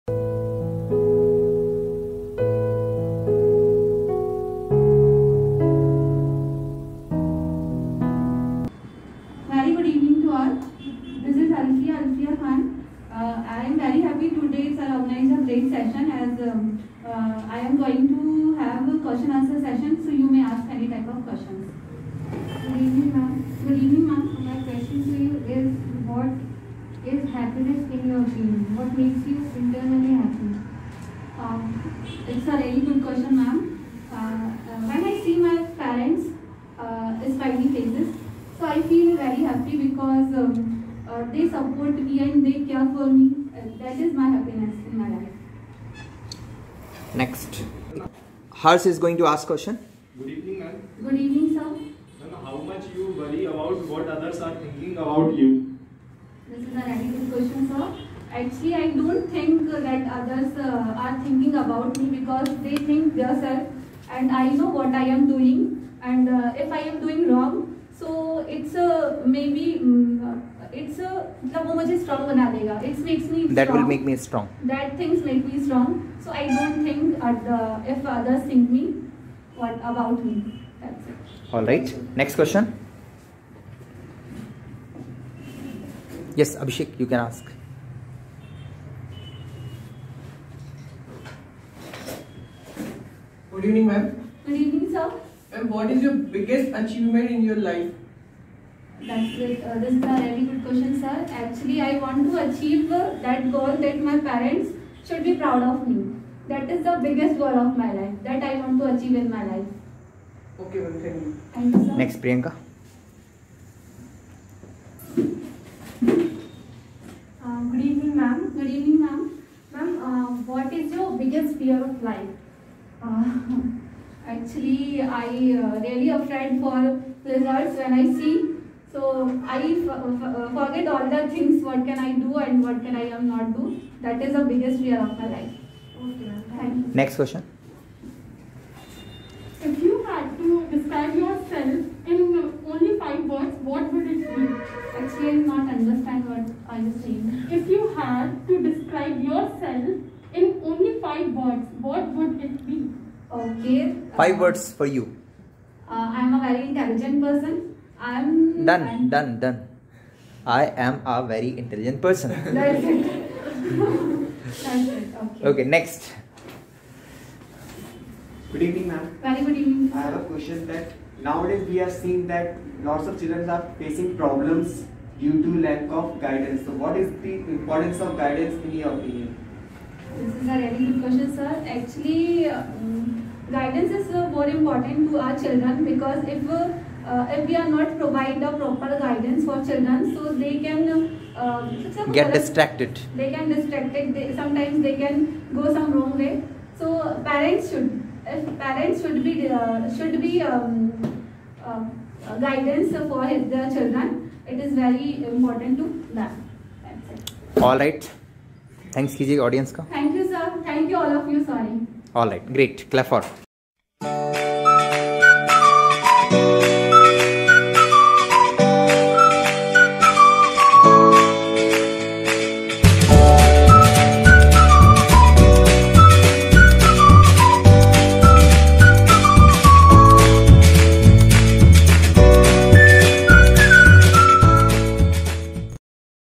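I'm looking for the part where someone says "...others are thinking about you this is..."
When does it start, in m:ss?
0:54.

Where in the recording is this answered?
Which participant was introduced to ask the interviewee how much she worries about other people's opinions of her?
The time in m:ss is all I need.
0:48.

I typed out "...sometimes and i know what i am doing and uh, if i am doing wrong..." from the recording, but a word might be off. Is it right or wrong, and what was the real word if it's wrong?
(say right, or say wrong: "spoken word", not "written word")
wrong: "themselves", not "sometimes".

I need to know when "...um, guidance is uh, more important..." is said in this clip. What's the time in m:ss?
3:02.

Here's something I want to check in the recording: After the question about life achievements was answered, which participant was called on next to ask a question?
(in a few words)
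Priyanka.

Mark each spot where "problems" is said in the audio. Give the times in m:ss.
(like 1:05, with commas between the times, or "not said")
2:54.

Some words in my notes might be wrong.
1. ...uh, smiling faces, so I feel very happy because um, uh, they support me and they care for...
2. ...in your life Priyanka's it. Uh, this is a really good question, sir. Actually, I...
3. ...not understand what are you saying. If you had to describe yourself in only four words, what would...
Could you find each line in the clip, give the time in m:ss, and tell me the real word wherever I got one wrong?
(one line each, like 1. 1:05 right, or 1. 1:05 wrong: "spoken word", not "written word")
1. 0:36 right
2. 1:37 wrong: "That", not "Priyanka"
3. 2:25 wrong: "five", not "four".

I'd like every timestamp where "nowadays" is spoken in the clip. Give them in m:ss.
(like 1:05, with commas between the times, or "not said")
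2:51.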